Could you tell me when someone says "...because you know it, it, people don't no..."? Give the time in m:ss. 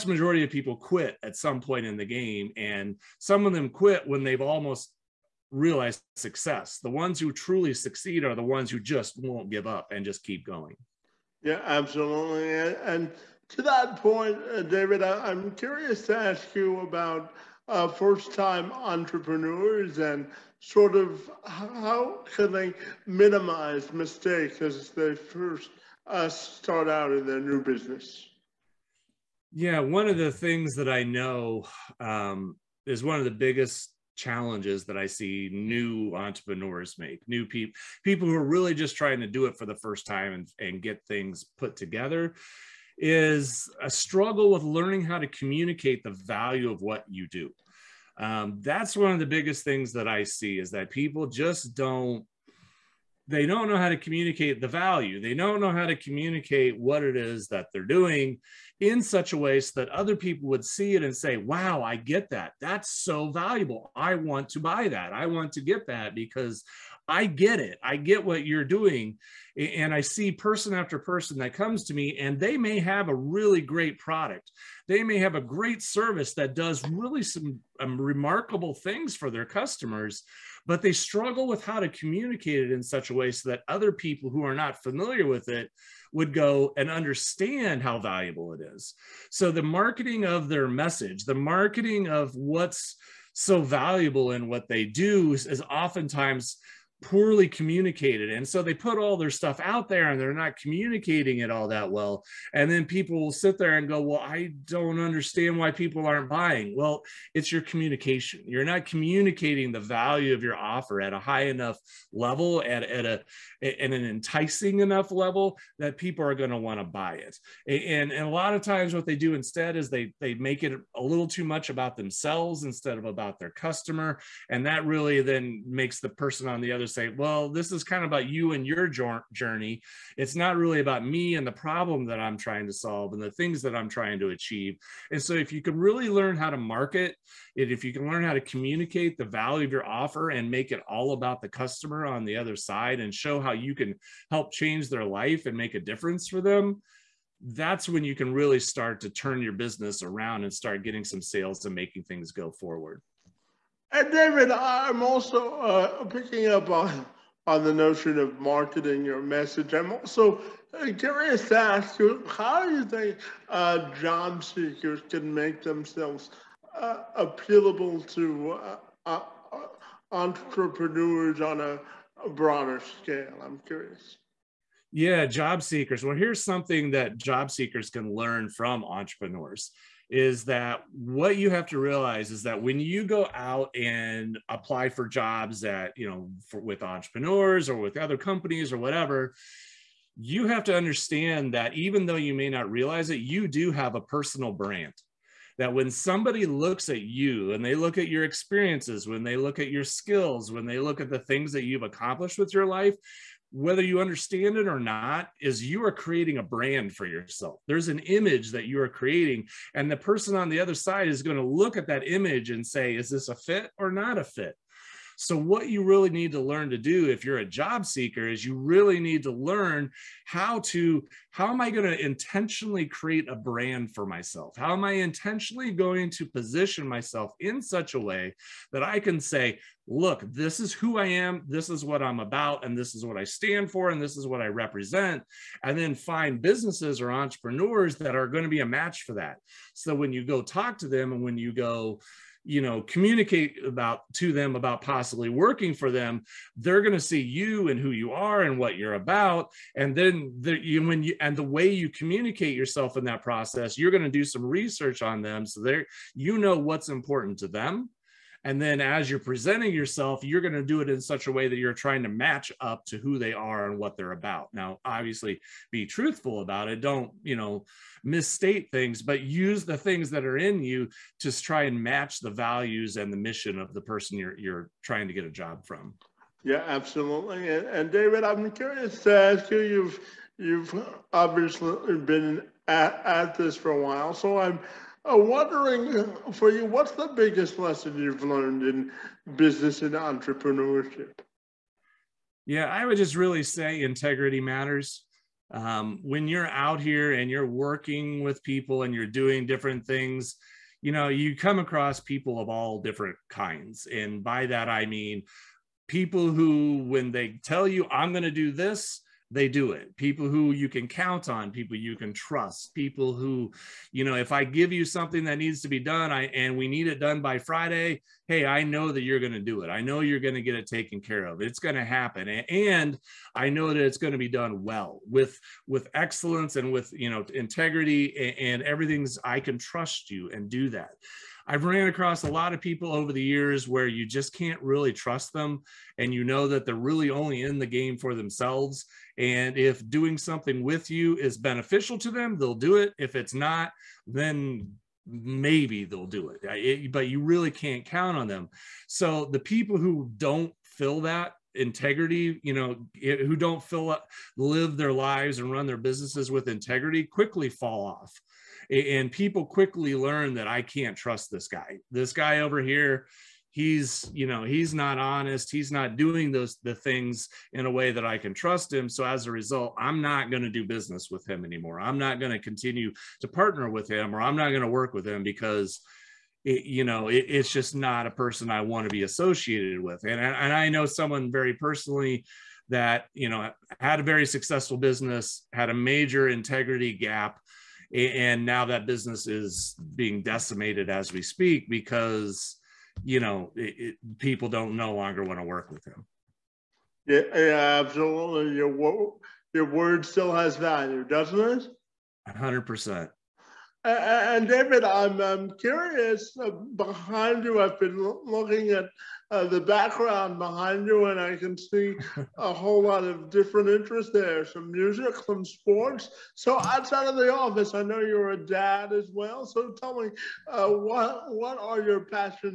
6:31.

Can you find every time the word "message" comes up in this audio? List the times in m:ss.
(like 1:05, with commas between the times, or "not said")
1:30, 2:39.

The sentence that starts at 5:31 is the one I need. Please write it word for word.
I've ran across a lot of people over the years where you just can't really trust them.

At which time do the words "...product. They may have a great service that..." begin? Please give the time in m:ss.
1:13.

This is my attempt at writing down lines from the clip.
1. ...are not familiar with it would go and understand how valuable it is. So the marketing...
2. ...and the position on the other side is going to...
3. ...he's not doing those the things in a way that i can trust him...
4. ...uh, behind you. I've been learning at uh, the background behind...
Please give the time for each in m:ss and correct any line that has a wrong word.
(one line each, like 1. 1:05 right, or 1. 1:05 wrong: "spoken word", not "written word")
1. 1:24 right
2. 3:29 wrong: "person", not "position"
3. 6:05 right
4. 6:46 wrong: "looking", not "learning".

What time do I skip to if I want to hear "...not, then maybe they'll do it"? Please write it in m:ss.
5:43.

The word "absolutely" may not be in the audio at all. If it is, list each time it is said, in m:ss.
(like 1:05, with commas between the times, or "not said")
0:11, 4:36, 6:37.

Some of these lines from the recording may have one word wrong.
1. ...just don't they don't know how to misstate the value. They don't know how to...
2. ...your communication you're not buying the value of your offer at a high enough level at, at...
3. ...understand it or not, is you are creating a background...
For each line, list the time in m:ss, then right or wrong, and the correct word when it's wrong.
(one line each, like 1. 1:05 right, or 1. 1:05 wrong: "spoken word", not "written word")
1. 0:51 wrong: "communicate", not "misstate"
2. 1:47 wrong: "communicating", not "buying"
3. 3:24 wrong: "brand", not "background".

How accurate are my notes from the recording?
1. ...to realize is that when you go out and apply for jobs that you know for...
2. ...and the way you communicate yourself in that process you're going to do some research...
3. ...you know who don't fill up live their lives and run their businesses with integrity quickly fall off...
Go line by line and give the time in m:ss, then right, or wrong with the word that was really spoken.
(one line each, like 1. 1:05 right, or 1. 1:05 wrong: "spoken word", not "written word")
1. 3:01 right
2. 4:11 right
3. 5:52 right.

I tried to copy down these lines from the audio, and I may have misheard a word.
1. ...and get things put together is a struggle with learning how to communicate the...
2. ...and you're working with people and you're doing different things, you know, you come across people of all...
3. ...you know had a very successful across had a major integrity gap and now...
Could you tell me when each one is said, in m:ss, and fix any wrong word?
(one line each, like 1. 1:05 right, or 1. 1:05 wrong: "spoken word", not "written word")
1. 0:40 right
2. 4:57 right
3. 6:23 wrong: "business", not "across".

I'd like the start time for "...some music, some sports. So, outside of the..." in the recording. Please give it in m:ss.
6:54.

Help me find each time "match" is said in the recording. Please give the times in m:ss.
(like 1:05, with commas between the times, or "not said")
3:58, 4:22, 4:31.